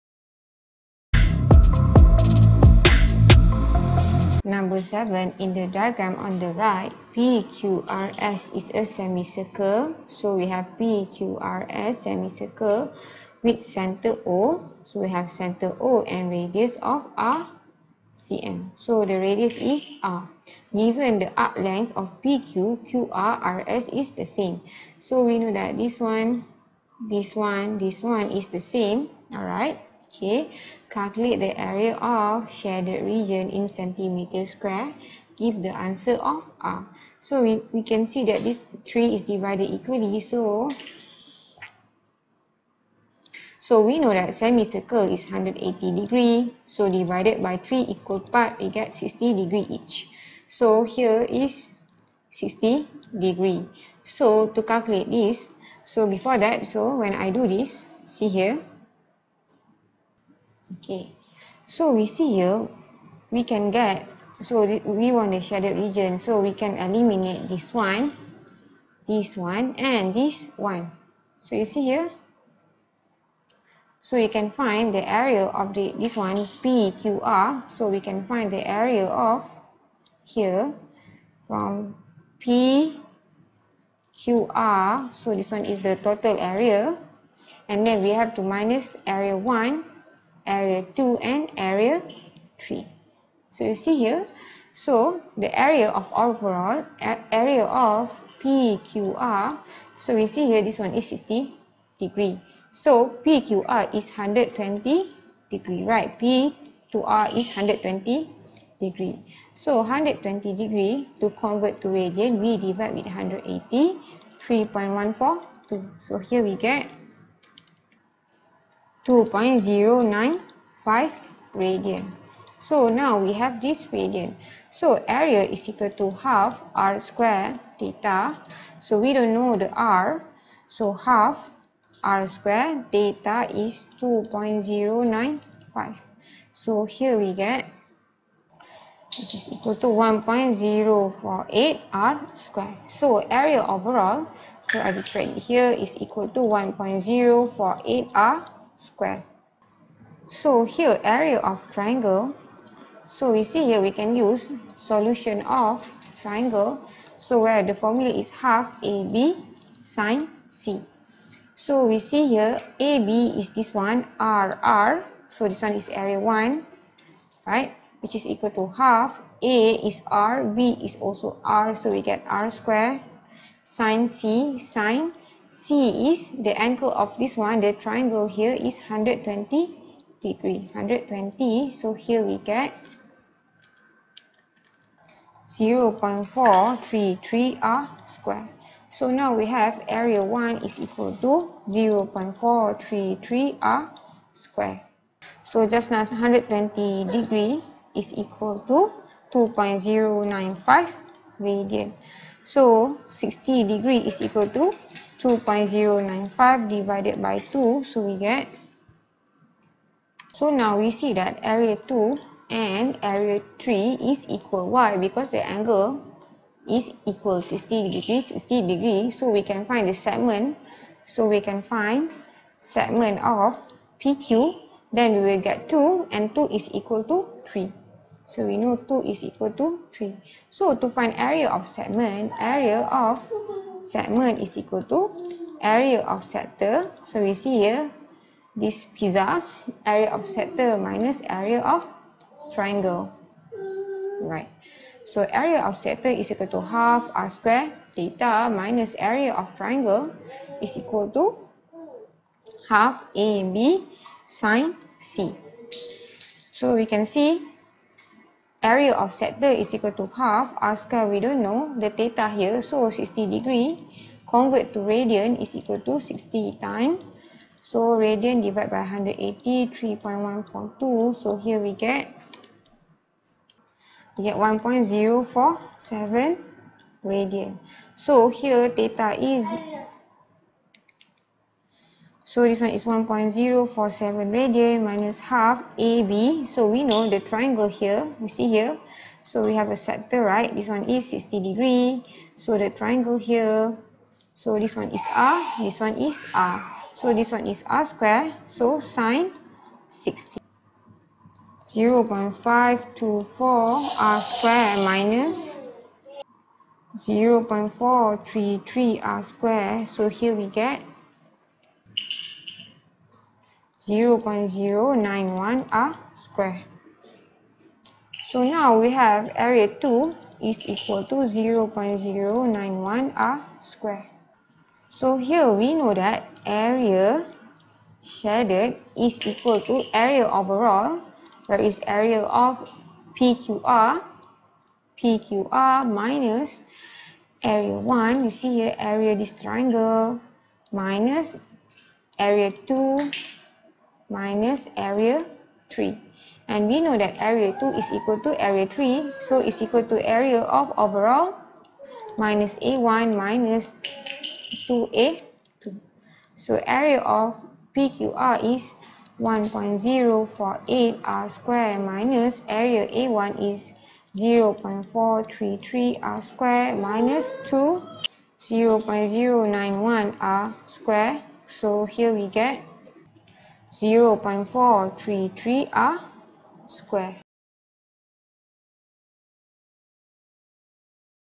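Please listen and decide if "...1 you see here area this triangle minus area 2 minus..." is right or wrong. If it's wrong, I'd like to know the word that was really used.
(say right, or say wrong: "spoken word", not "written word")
right.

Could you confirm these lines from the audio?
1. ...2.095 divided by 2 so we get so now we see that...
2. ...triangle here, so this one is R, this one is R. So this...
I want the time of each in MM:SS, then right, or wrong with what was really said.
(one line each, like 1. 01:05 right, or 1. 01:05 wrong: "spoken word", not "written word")
1. 03:25 right
2. 04:52 right.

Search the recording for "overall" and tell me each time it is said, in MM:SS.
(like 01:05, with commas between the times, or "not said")
01:36, 02:23, 05:30, 05:50.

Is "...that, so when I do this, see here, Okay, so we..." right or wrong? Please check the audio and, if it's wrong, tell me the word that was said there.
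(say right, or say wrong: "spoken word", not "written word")
right.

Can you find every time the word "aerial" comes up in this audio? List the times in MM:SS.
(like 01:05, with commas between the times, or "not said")
not said.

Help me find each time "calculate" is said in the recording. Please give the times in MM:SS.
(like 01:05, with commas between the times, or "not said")
00:30, 00:54.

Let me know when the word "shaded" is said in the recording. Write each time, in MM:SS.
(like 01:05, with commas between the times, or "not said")
00:32, 01:05, 05:28.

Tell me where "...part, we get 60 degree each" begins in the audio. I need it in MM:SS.
00:48.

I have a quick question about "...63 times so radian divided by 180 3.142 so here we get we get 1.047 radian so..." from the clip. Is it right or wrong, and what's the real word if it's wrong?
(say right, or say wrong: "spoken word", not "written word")
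wrong: "60", not "63".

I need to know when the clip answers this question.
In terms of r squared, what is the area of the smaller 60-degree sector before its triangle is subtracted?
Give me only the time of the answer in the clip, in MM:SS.
05:01.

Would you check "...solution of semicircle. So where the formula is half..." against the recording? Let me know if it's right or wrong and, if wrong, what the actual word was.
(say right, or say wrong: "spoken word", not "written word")
wrong: "triangle", not "semicircle".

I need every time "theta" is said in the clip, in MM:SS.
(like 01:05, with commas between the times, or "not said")
02:07, 02:12, 04:07, 04:21, 04:38.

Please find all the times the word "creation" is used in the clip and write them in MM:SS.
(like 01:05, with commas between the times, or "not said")
not said.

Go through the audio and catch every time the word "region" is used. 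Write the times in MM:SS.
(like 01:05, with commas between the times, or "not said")
00:33, 01:05.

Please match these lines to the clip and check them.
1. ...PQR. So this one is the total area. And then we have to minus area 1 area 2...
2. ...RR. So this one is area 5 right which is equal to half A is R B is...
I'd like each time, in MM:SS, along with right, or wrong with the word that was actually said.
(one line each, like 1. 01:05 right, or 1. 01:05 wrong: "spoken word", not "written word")
1. 01:22 right
2. 02:44 wrong: "1", not "5".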